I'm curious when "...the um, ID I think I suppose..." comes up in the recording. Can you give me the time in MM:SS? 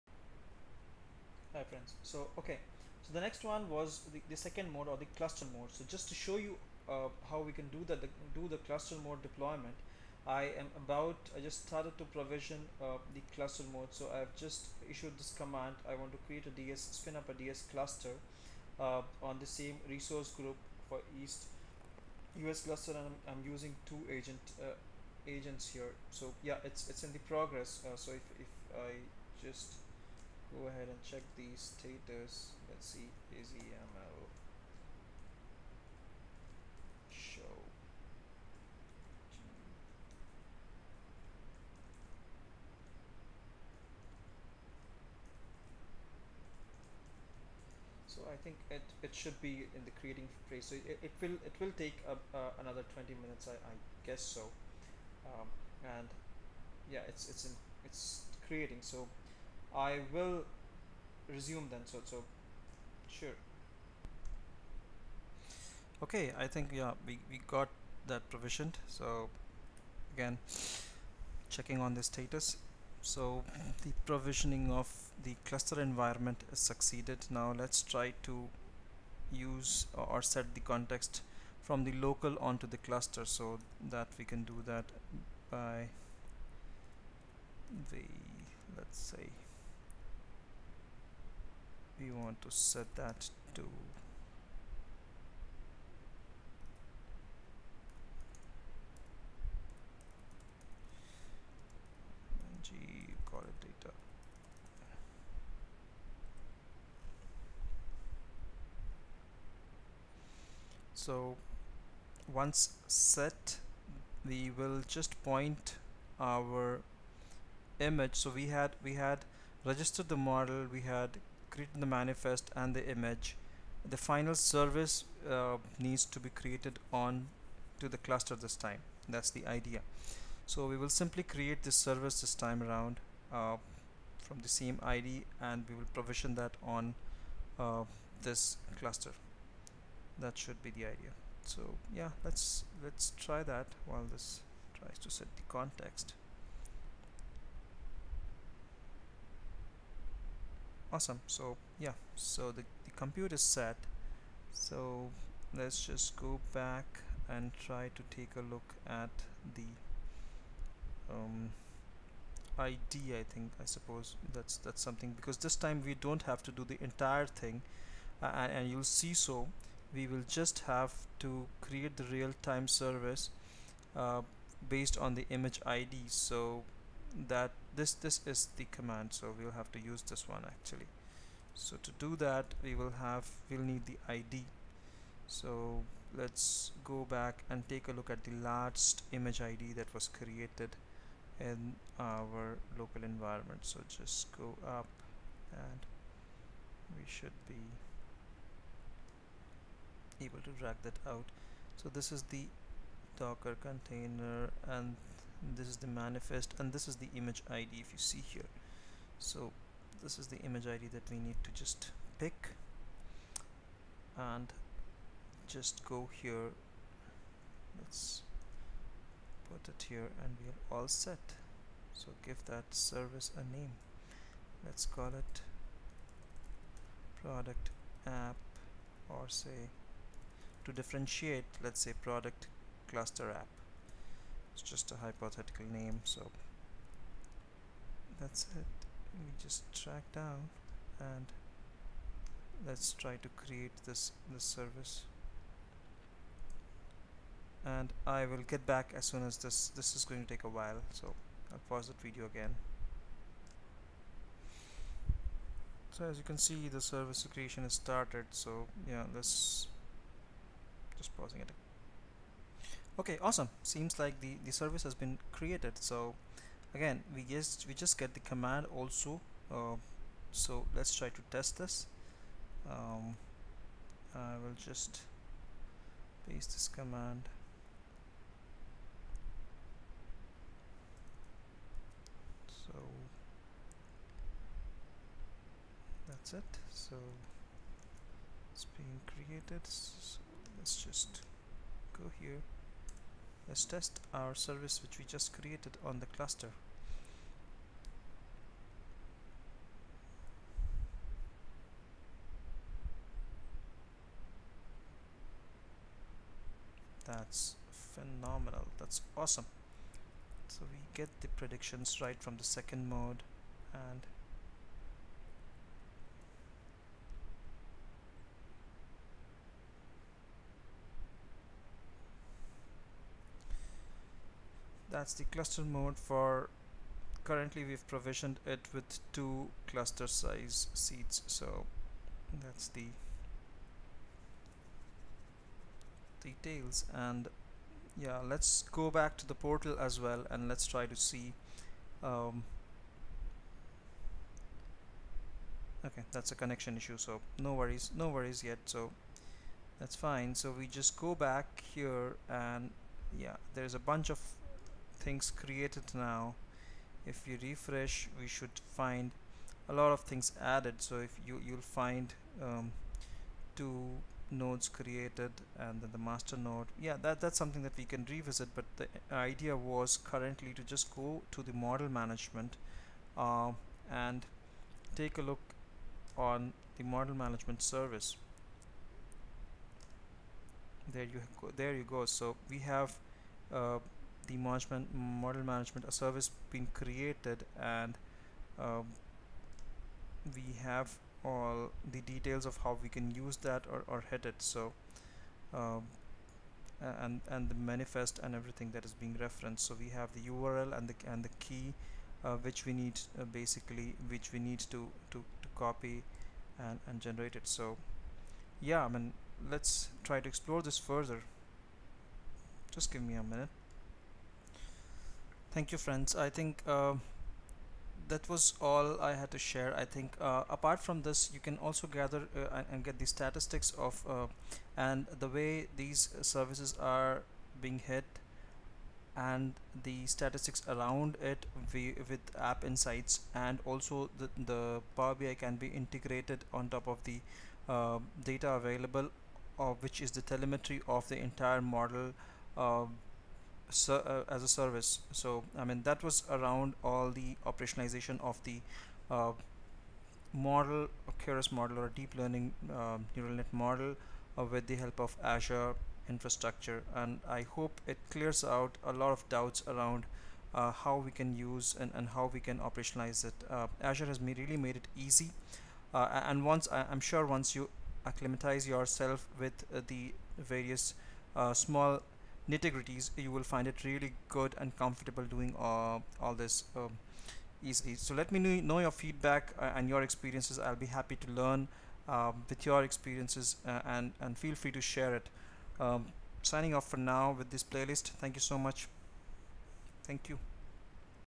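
02:39.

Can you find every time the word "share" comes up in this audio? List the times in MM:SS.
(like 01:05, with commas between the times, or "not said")
06:59, 08:04.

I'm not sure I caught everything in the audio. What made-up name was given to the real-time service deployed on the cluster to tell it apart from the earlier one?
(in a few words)
product cluster app.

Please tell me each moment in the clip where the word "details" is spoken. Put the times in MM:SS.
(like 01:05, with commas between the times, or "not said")
05:36, 06:32.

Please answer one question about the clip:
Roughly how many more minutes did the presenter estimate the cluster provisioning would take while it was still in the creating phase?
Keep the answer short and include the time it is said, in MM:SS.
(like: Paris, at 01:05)
20, at 00:52.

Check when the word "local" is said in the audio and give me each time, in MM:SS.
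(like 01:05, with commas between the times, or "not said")
01:21, 03:12.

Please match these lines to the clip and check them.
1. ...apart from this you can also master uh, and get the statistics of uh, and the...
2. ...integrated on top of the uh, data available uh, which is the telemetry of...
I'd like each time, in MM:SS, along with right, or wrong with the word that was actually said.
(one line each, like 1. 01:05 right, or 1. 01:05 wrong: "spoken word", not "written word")
1. 07:00 wrong: "gather", not "master"
2. 07:15 right.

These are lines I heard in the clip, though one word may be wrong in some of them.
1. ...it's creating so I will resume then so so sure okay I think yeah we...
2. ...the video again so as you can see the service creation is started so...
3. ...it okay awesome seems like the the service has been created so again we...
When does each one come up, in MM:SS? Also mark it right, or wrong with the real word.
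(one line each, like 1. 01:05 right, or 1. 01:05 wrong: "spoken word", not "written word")
1. 00:57 right
2. 04:11 right
3. 04:21 right.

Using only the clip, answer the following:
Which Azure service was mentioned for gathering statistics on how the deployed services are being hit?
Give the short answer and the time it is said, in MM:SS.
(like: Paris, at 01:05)
App Insights, at 07:12.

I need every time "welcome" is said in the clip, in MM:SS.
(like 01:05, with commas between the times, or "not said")
not said.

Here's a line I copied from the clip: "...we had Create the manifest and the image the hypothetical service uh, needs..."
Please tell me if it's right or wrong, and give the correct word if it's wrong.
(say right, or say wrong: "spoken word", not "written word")
wrong: "final", not "hypothetical".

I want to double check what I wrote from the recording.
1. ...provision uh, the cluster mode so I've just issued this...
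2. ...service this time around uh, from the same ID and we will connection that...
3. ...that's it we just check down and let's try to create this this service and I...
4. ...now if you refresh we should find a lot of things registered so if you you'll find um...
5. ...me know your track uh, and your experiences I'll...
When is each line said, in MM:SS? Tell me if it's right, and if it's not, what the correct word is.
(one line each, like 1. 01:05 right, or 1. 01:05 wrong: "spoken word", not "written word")
1. 00:12 right
2. 02:11 wrong: "provision", not "connection"
3. 03:58 wrong: "track", not "check"
4. 05:55 wrong: "added", not "registered"
5. 07:58 wrong: "feedback", not "track".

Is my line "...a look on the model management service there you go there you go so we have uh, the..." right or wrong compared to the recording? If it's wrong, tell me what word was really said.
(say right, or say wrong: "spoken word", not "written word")
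right.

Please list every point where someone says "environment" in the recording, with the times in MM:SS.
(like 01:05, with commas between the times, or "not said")
01:15, 03:13.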